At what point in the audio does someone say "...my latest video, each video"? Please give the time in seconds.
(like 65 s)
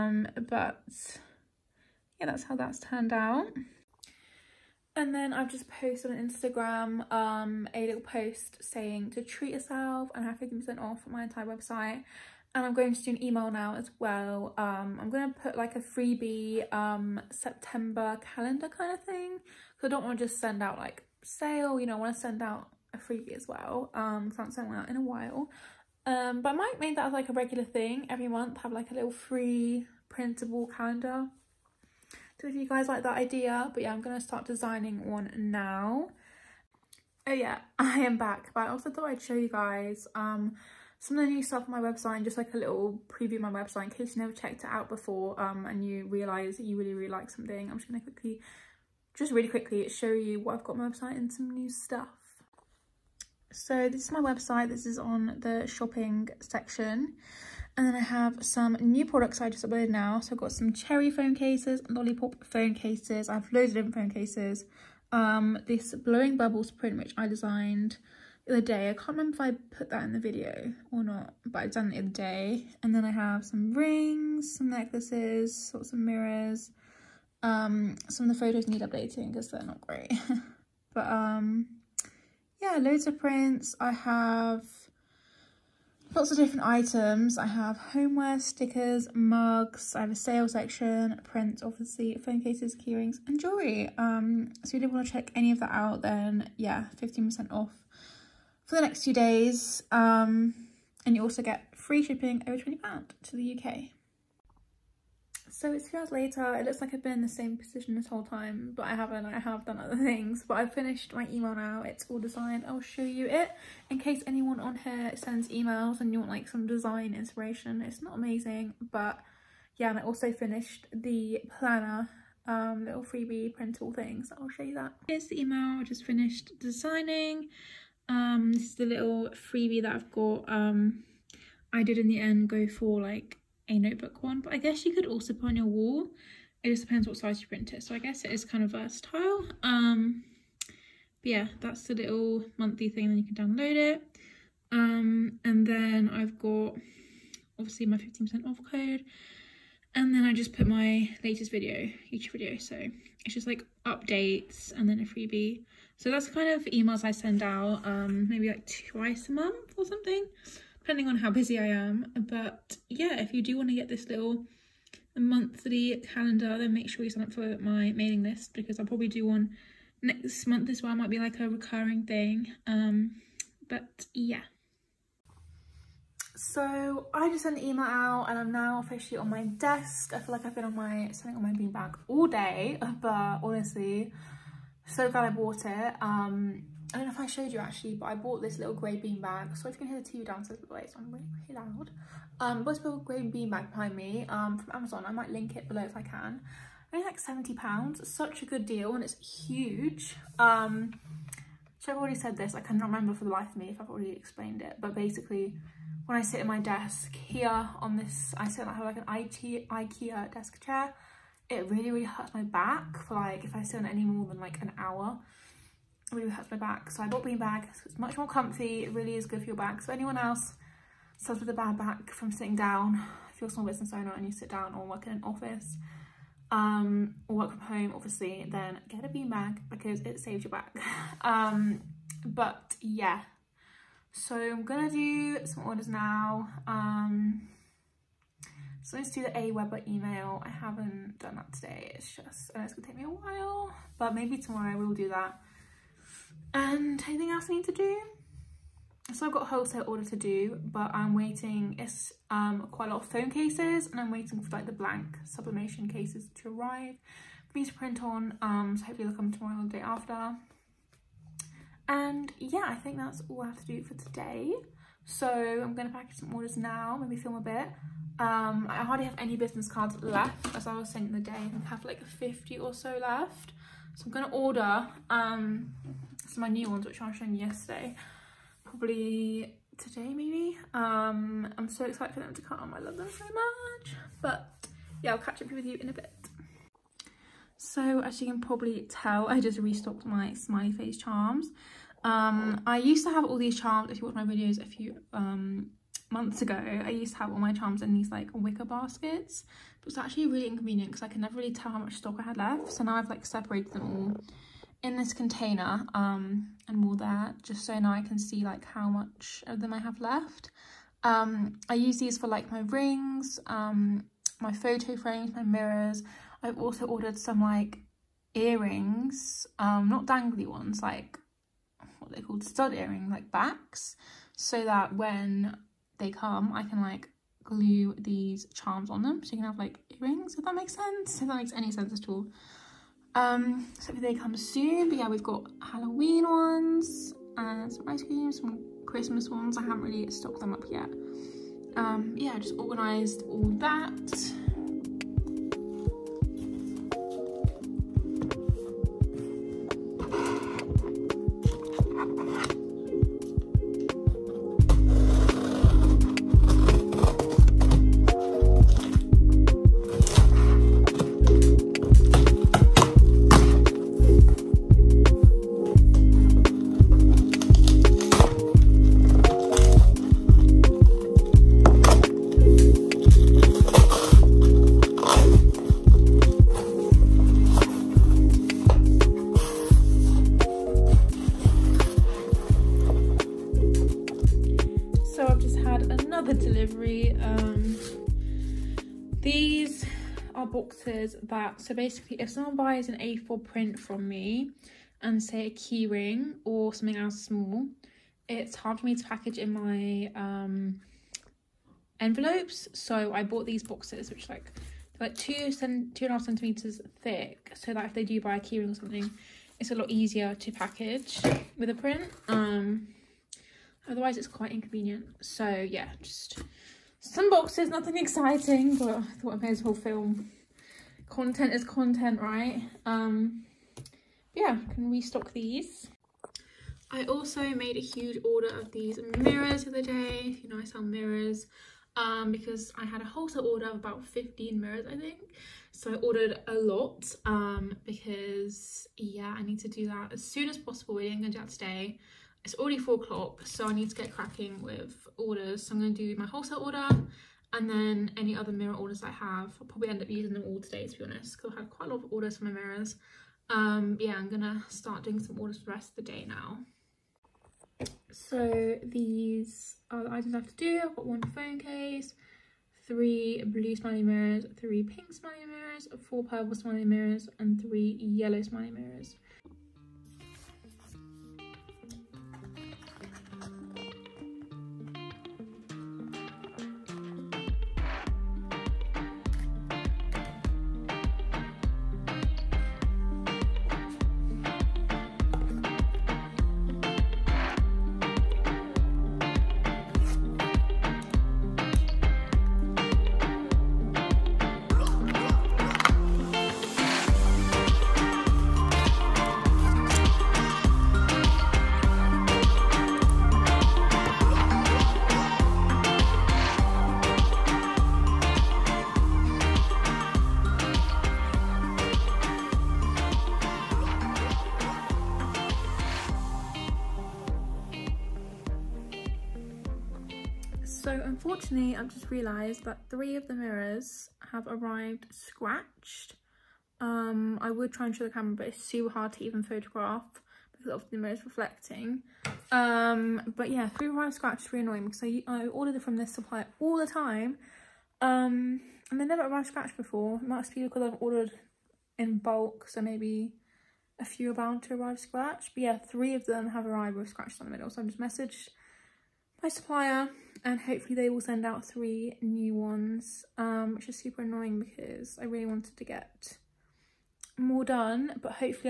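150 s.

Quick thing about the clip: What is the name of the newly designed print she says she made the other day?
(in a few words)
Blowing bubbles.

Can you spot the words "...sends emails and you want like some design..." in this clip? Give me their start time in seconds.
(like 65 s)
115 s.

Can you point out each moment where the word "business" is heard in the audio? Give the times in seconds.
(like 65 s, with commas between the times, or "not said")
223 s, 269 s.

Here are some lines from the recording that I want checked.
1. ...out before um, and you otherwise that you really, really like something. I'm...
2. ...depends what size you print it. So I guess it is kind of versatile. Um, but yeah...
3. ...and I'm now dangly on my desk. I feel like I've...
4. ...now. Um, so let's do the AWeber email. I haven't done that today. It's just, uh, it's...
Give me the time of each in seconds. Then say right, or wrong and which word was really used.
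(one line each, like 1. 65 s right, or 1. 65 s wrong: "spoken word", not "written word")
1. 44 s wrong: "realise", not "otherwise"
2. 136 s right
3. 178 s wrong: "officially", not "dangly"
4. 235 s right.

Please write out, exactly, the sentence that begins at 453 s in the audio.
Um, yeah, I'm gonna start doing some orders for the rest of the day now.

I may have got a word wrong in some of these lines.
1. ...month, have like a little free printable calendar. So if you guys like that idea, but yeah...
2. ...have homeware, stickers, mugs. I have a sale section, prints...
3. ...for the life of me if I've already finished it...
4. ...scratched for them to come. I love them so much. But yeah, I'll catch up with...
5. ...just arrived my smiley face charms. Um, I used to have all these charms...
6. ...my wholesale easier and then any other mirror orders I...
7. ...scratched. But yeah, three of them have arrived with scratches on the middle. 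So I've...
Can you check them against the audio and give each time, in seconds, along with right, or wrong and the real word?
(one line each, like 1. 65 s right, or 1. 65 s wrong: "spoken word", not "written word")
1. 28 s right
2. 87 s right
3. 203 s wrong: "explained", not "finished"
4. 281 s wrong: "excited", not "scratched"
5. 289 s wrong: "restocked", not "arrived"
6. 446 s wrong: "order", not "easier"
7. 544 s right.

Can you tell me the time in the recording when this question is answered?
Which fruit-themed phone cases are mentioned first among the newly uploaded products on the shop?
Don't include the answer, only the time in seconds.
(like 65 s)
60 s.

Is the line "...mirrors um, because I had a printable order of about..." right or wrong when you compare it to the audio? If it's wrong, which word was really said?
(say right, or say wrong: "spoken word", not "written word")
wrong: "wholesale", not "printable".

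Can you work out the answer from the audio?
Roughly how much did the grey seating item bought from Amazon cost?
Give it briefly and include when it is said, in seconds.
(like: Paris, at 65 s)
£70, at 197 s.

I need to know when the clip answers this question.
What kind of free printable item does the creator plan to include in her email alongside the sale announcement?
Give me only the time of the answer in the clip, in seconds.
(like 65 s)
17 s.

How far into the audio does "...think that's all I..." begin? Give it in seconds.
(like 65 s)
262 s.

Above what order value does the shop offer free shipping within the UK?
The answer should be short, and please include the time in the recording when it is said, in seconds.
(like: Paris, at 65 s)
£20, at 102 s.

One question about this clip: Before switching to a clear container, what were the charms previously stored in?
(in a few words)
Wicker baskets.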